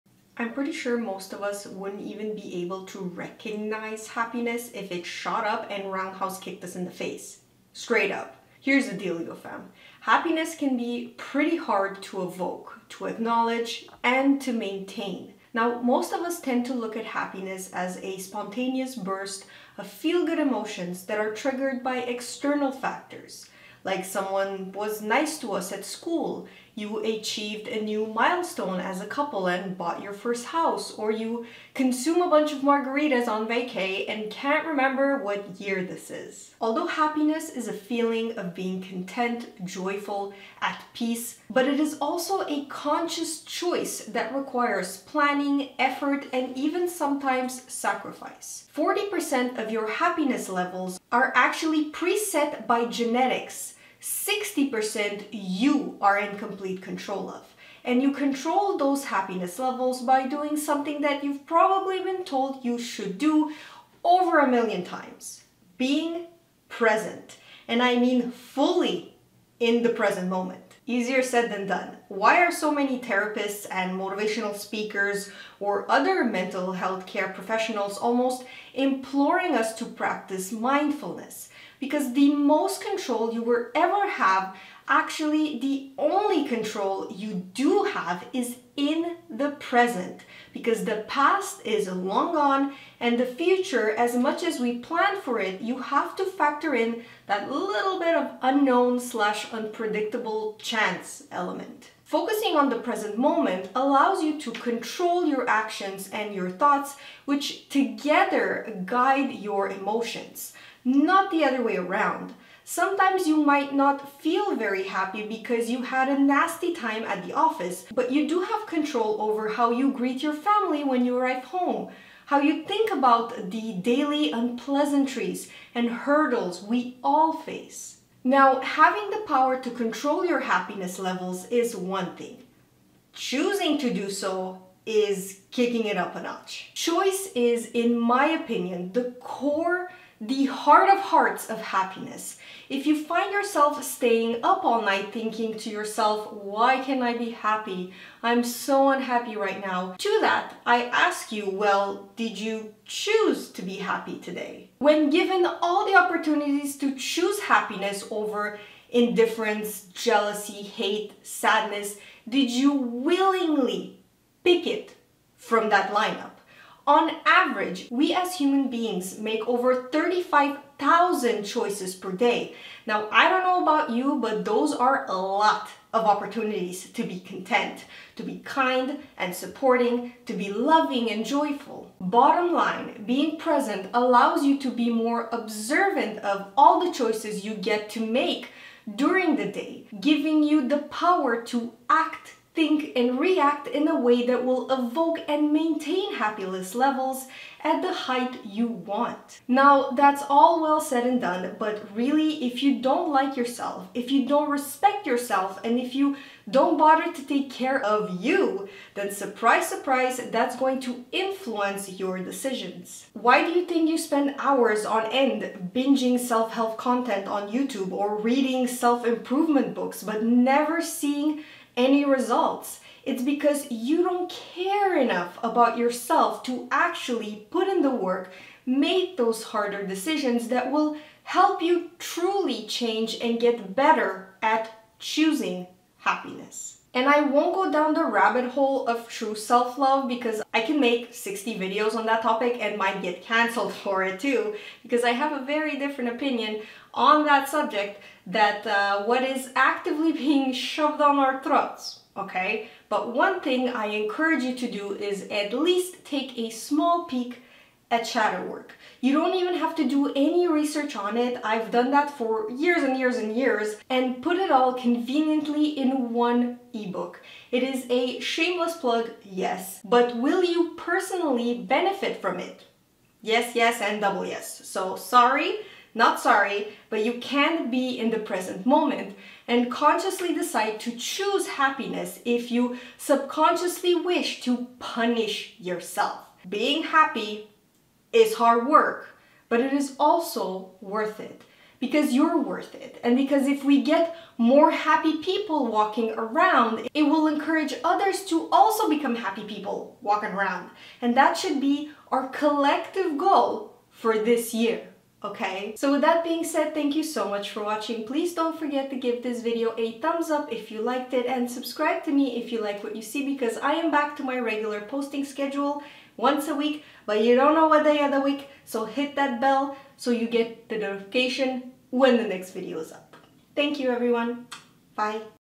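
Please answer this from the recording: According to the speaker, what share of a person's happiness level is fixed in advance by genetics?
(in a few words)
40%.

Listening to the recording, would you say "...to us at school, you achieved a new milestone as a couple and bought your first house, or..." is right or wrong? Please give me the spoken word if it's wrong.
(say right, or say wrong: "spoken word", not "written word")
right.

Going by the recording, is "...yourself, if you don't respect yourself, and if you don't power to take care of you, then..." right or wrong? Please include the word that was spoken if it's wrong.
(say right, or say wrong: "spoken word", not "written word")
wrong: "bother", not "power".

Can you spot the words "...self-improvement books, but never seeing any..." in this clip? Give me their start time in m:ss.
3:38.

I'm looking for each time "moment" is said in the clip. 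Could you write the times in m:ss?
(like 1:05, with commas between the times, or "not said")
1:10, 1:43, 4:38.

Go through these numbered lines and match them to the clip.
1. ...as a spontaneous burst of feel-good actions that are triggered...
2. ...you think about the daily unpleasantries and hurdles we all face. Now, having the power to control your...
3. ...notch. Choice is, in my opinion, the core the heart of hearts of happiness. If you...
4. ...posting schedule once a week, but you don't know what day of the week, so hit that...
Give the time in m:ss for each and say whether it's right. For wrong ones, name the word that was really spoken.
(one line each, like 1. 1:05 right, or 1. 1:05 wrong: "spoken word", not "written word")
1. 0:17 wrong: "emotions", not "actions"
2. 2:02 right
3. 2:16 right
4. 5:14 right.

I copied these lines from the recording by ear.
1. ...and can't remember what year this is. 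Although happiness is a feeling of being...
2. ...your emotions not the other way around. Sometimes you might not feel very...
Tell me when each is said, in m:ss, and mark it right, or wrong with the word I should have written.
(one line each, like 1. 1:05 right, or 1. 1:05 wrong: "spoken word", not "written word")
1. 0:34 right
2. 1:49 right.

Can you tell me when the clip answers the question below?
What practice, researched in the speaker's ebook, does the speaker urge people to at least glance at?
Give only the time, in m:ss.
4:18.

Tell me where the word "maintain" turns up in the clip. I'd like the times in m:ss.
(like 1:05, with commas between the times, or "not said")
0:14, 3:15.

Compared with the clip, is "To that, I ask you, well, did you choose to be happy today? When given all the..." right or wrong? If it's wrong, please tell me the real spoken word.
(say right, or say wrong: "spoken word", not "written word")
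right.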